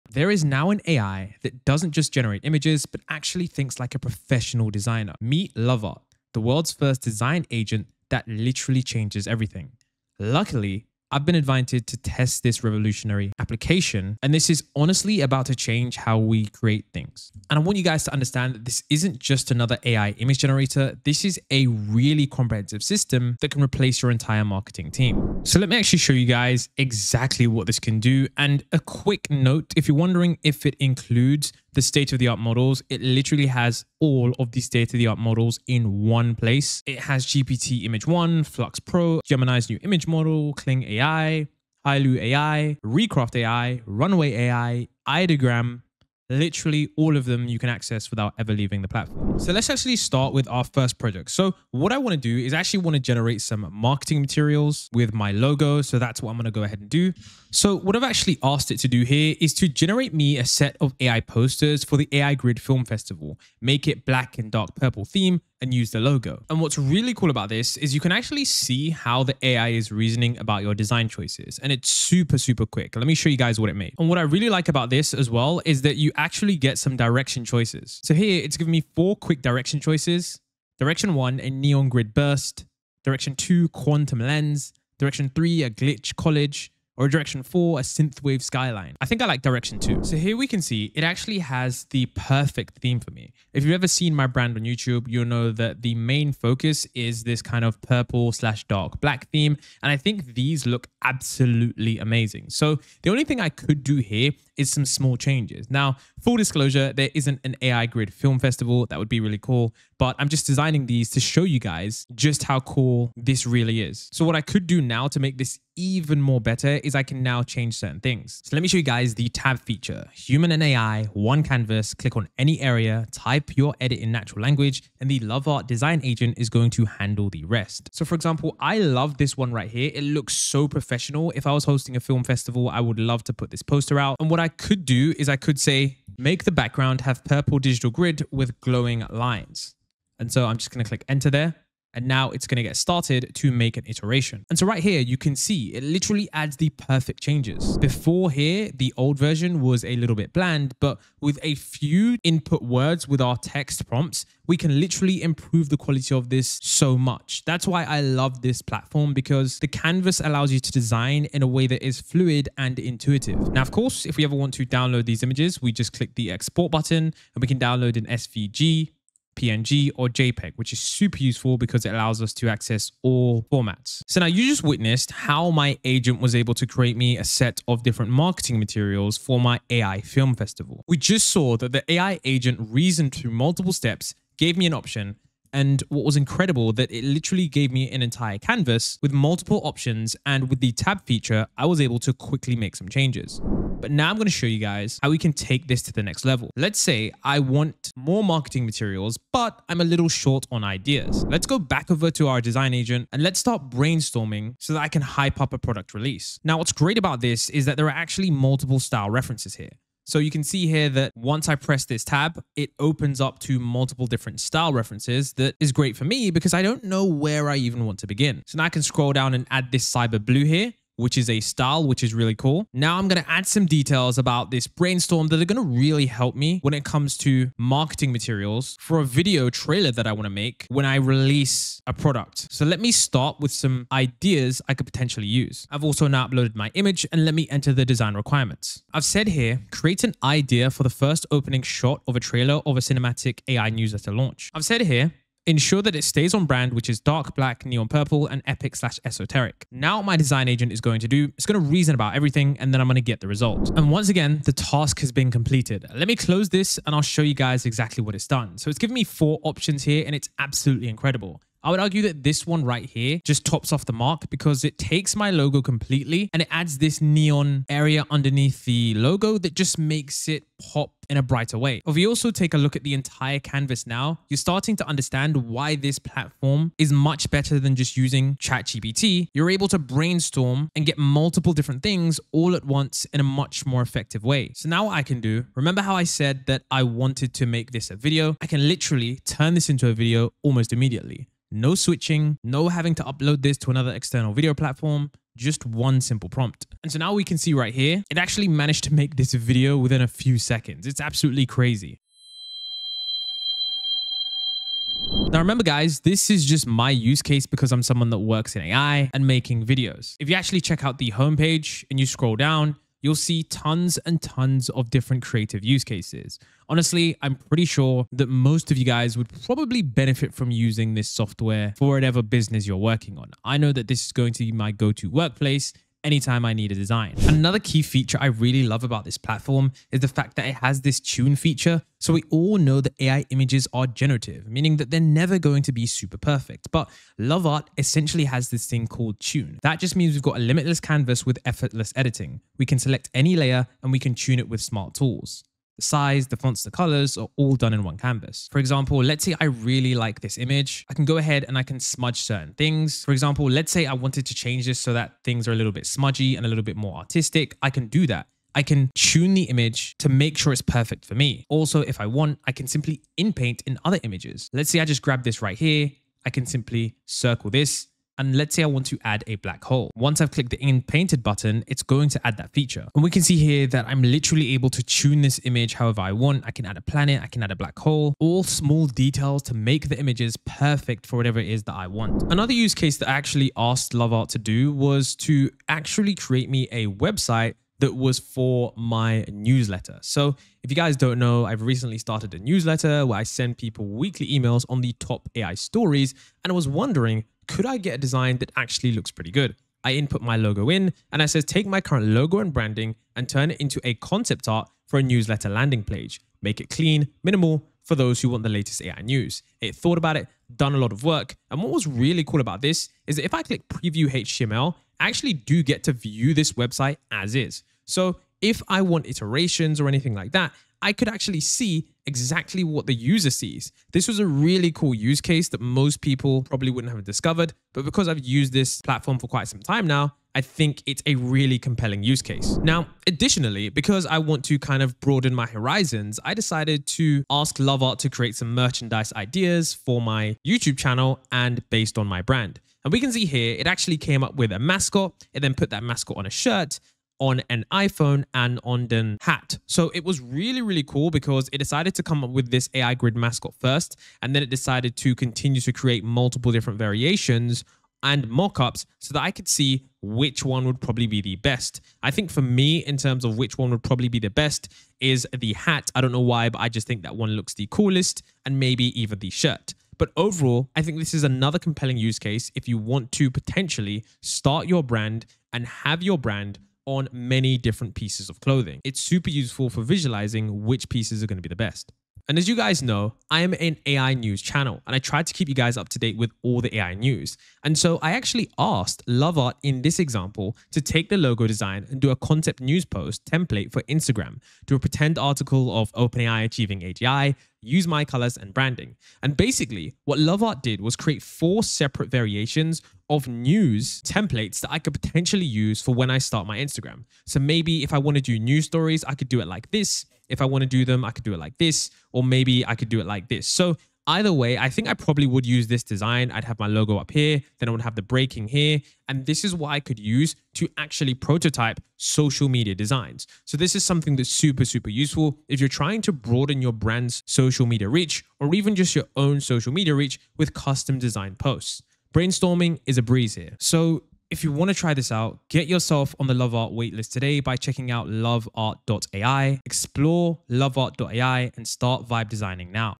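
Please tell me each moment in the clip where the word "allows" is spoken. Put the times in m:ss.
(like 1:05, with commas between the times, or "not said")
2:40, 2:51.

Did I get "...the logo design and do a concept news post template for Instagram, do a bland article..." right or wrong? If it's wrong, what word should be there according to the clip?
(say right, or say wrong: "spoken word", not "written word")
wrong: "pretend", not "bland".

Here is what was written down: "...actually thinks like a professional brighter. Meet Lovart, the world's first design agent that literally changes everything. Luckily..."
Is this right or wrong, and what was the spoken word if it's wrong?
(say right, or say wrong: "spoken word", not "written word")
wrong: "designer", not "brighter".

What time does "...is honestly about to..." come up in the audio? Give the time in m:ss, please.
0:14.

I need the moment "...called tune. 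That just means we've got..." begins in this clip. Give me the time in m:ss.
5:38.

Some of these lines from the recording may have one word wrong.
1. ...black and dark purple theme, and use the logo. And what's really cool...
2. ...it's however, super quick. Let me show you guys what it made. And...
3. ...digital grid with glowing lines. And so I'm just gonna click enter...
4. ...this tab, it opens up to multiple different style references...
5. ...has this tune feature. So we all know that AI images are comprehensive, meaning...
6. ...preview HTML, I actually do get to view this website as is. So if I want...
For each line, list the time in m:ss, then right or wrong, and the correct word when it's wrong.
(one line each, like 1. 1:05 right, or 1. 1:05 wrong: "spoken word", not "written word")
1. 1:04 right
2. 1:11 wrong: "super", not "however"
3. 2:17 right
4. 3:31 right
5. 5:30 wrong: "generative", not "comprehensive"
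6. 6:53 right.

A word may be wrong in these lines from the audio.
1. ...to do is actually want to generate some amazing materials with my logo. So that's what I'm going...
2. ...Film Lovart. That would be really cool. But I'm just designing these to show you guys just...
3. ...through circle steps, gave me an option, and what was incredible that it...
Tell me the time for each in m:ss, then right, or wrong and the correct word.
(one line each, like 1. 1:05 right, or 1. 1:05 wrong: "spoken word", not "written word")
1. 0:52 wrong: "marketing", not "amazing"
2. 1:48 wrong: "Festival", not "Lovart"
3. 3:03 wrong: "multiple", not "circle".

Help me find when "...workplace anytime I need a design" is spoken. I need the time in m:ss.
5:25.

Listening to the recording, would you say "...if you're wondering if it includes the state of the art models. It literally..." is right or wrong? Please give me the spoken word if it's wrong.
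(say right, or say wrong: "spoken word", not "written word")
right.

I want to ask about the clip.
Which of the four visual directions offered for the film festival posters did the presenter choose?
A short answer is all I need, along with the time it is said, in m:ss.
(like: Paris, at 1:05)
Quantum lens, at 1:23.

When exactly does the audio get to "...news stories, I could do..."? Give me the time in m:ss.
8:28.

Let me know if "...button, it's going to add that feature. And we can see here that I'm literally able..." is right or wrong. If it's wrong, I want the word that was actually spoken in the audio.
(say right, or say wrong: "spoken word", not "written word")
right.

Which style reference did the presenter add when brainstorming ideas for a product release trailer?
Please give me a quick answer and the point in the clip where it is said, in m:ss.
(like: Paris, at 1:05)
Cyber blue, at 3:39.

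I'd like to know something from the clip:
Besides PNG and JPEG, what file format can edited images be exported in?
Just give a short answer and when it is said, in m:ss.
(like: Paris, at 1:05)
SVG, at 2:48.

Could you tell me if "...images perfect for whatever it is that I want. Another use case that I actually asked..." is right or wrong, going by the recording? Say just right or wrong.
right.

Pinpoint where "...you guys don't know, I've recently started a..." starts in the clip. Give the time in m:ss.
6:30.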